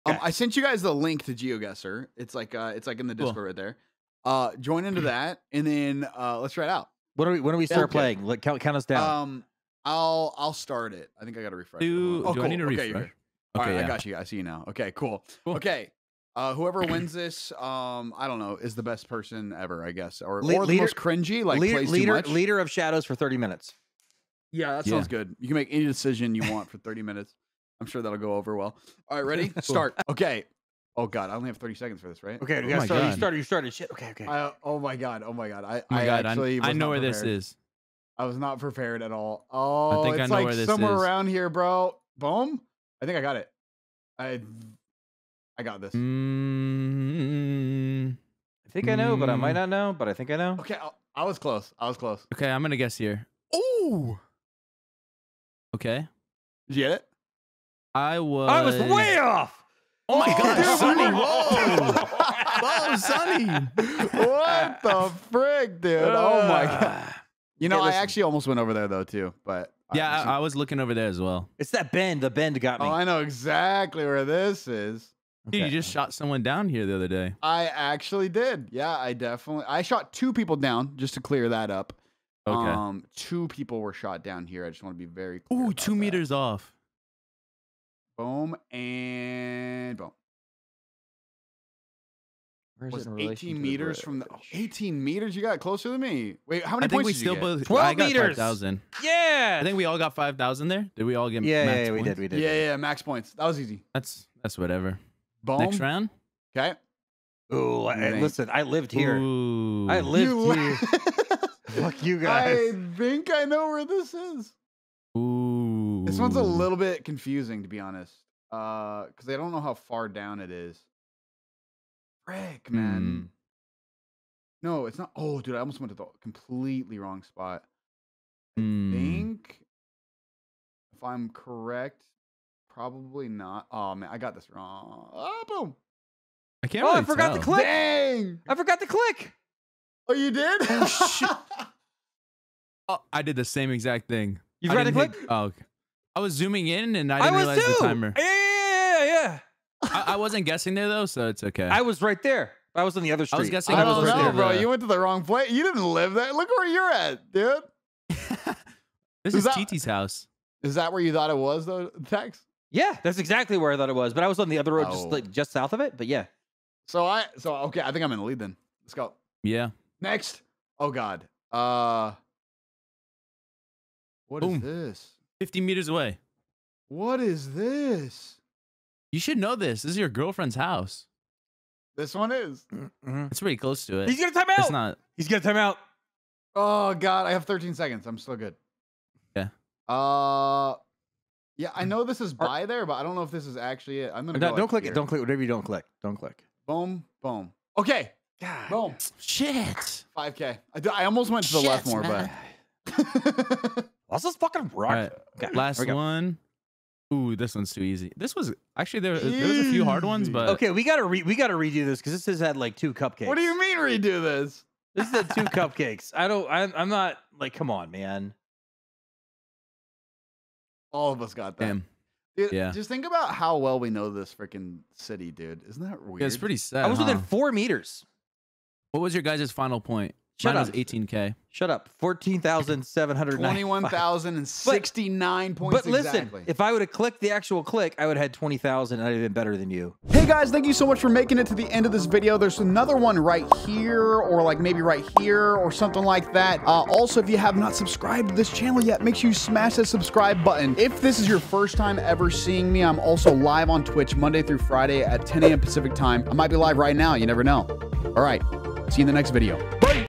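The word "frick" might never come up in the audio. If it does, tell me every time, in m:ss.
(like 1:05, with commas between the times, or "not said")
1:05, 2:02.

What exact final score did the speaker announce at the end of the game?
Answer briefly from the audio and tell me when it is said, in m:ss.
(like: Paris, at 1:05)
21,069, at 3:53.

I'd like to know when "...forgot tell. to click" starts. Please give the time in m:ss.
2:17.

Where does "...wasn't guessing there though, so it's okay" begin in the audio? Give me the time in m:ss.
2:30.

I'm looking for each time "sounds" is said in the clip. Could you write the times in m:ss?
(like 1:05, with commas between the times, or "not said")
0:24.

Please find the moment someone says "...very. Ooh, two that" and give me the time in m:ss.
1:25.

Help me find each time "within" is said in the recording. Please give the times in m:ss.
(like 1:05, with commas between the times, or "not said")
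3:47.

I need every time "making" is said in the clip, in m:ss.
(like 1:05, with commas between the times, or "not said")
4:01.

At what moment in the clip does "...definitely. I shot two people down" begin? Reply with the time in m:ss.
1:19.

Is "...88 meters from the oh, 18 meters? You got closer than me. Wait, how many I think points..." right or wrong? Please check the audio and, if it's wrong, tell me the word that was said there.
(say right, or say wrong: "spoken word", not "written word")
wrong: "18", not "88".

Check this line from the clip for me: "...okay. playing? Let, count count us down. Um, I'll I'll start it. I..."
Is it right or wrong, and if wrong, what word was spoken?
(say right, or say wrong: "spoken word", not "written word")
right.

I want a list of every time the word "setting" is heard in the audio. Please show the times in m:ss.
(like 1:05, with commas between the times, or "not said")
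not said.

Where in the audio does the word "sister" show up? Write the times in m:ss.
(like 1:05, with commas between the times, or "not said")
not said.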